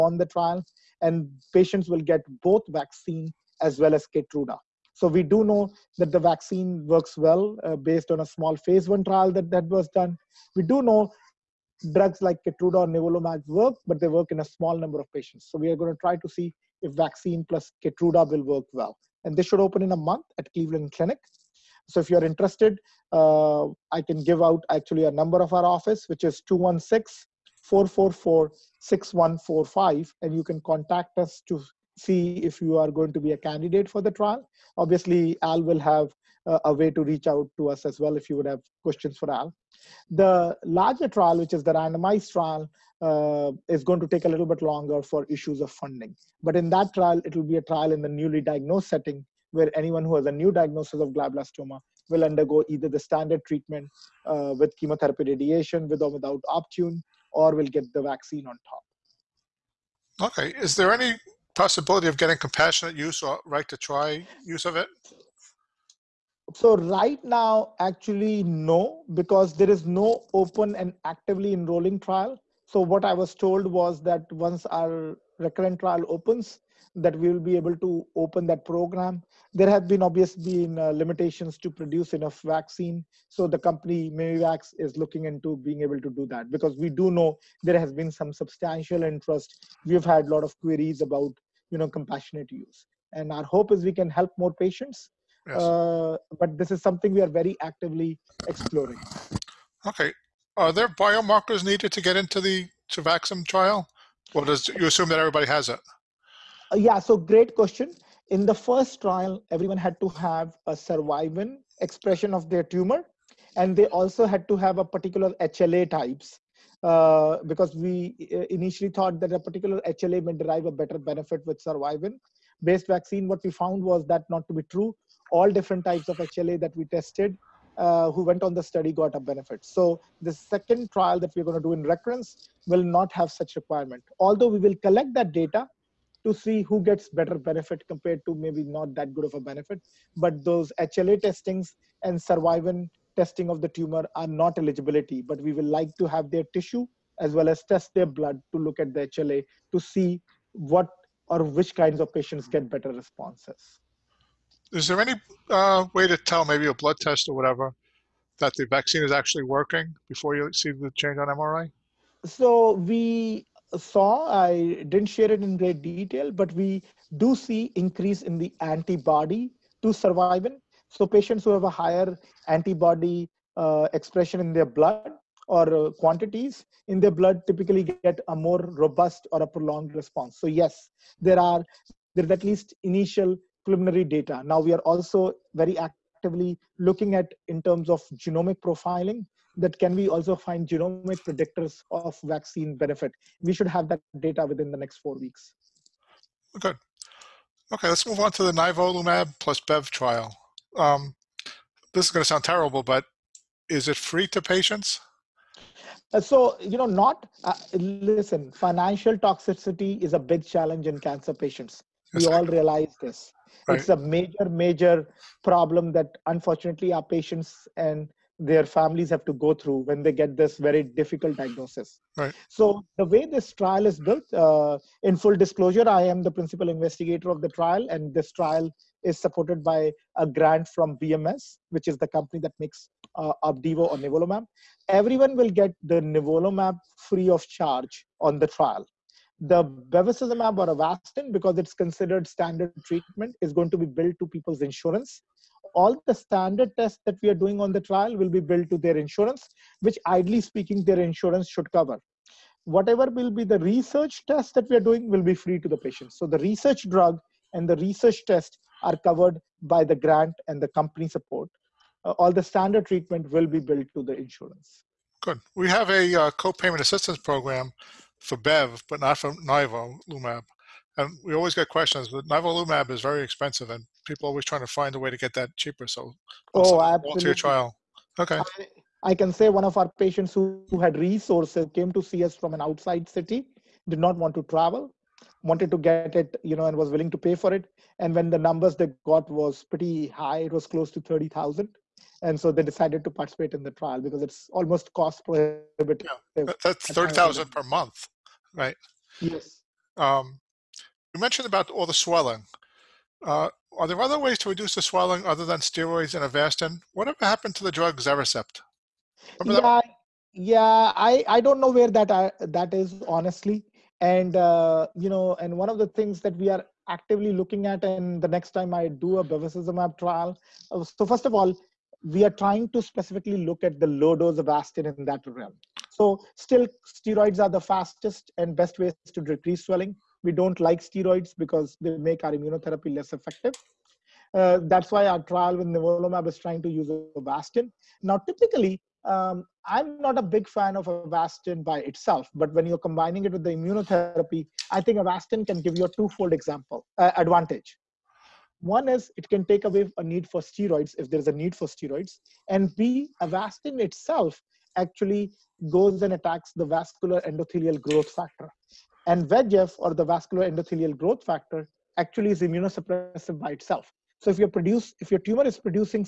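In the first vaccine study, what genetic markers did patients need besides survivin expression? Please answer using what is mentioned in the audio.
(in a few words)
HLA types.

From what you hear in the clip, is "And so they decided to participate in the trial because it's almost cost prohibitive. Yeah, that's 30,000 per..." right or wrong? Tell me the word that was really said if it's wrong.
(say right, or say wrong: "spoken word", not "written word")
right.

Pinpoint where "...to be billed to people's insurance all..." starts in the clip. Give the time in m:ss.
4:03.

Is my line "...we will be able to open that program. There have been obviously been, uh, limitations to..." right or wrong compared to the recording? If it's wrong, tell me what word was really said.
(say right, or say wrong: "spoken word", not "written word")
right.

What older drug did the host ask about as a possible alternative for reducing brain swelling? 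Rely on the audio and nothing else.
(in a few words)
Xerecept.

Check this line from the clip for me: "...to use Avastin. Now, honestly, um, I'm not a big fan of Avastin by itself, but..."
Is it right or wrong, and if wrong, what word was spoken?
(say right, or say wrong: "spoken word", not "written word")
wrong: "typically", not "honestly".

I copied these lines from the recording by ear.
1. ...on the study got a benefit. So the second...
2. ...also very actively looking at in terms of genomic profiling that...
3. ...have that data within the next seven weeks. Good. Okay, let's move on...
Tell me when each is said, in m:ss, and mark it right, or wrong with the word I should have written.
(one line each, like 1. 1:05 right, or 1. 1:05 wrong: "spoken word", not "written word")
1. 2:08 right
2. 3:04 right
3. 3:13 wrong: "four", not "seven".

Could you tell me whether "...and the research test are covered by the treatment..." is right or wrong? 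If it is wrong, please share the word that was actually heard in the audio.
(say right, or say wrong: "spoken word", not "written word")
wrong: "grant", not "treatment".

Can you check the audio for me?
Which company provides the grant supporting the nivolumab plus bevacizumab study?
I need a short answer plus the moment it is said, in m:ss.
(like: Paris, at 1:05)
BMS, at 3:50.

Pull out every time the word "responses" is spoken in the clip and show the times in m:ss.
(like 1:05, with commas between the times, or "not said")
2:32, 2:59.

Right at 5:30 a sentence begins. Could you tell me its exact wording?
We don't like steroids because they make our immunotherapy less effective.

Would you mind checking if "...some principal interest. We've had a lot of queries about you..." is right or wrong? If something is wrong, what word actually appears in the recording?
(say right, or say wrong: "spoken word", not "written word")
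wrong: "substantial", not "principal".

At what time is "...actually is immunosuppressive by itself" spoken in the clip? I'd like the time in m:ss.
6:01.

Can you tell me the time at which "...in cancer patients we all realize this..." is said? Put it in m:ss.
3:30.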